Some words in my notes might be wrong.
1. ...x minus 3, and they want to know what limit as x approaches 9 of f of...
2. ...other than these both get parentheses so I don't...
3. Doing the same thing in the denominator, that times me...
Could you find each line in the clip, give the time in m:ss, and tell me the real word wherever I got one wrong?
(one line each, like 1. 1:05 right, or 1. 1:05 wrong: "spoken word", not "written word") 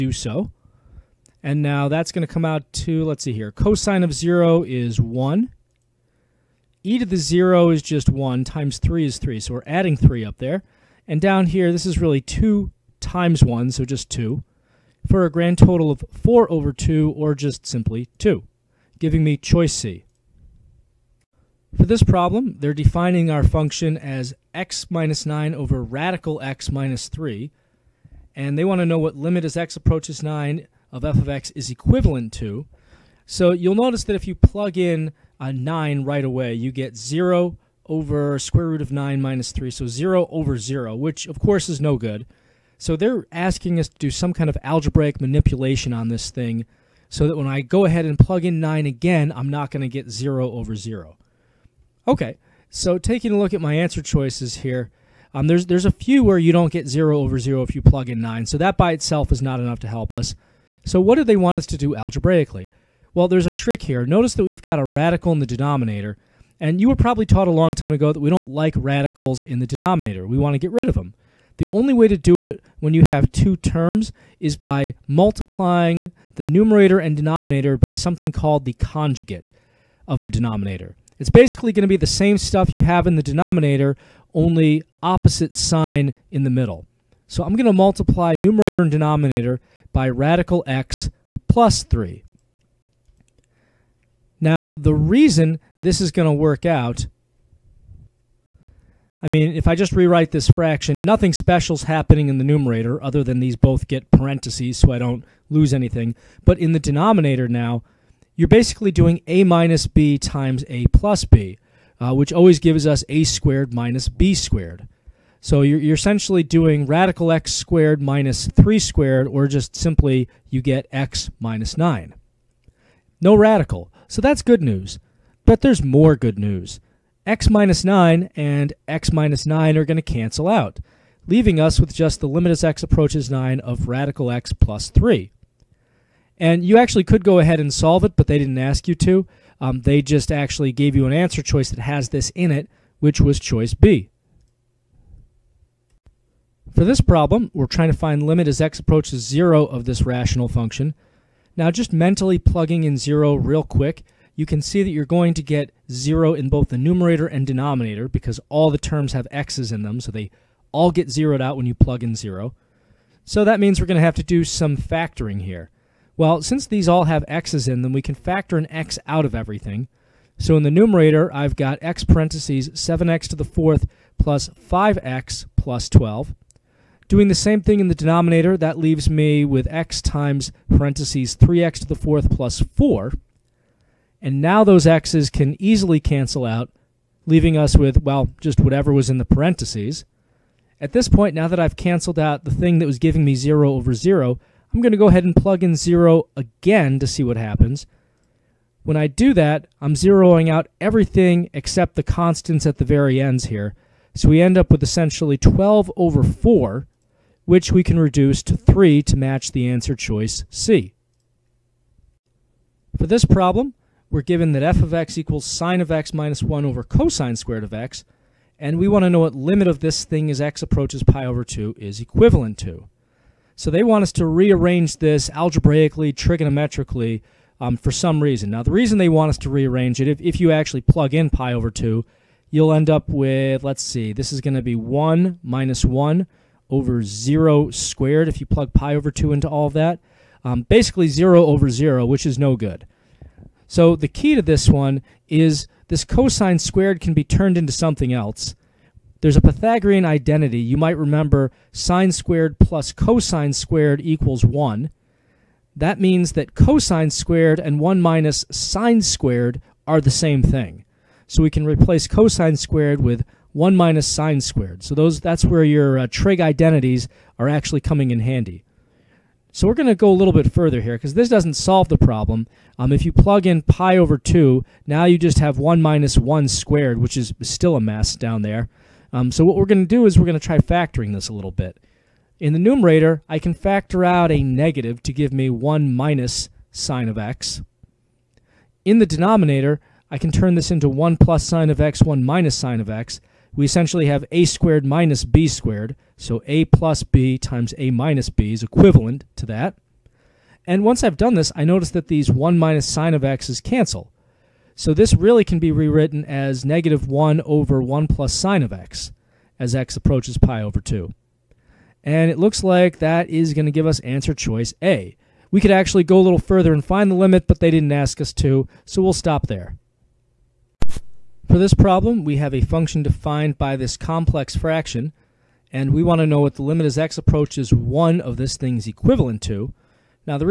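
1. 0:26 right
2. 1:43 right
3. 2:57 wrong: "leaves", not "times".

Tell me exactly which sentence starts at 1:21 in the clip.
It's basically going to be the same stuff you have in the denominator, only opposite sign in the middle.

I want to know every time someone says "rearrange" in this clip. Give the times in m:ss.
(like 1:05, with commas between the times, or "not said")
3:44, 3:49.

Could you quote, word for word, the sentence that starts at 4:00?
Um, basically 0 over 0, which is no good.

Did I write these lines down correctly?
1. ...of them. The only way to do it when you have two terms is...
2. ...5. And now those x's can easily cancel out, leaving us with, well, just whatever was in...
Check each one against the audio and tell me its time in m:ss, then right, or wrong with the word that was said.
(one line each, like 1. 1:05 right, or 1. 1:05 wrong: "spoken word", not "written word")
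1. 1:10 right
2. 3:02 wrong: "4", not "5".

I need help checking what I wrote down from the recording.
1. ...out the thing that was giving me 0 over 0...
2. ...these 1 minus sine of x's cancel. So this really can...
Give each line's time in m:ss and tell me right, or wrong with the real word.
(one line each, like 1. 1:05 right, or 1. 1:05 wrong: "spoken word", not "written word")
1. 3:12 right
2. 5:02 right.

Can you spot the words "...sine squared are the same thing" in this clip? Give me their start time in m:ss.
4:18.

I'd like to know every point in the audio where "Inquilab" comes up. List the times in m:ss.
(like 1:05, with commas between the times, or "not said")
not said.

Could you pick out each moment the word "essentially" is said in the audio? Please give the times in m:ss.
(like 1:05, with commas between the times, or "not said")
1:55, 3:24, 4:53.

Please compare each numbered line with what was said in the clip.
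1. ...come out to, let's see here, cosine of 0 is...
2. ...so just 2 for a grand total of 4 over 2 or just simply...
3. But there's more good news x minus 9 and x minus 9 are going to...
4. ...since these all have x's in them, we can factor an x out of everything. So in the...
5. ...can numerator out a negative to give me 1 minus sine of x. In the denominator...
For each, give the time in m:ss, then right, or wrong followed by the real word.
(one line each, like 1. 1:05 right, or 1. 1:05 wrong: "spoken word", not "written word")
1. 0:02 right
2. 0:13 right
3. 2:05 right
4. 2:46 right
5. 4:43 wrong: "factor", not "numerator".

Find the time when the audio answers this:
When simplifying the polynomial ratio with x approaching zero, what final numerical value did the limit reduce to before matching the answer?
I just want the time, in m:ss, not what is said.
3:27.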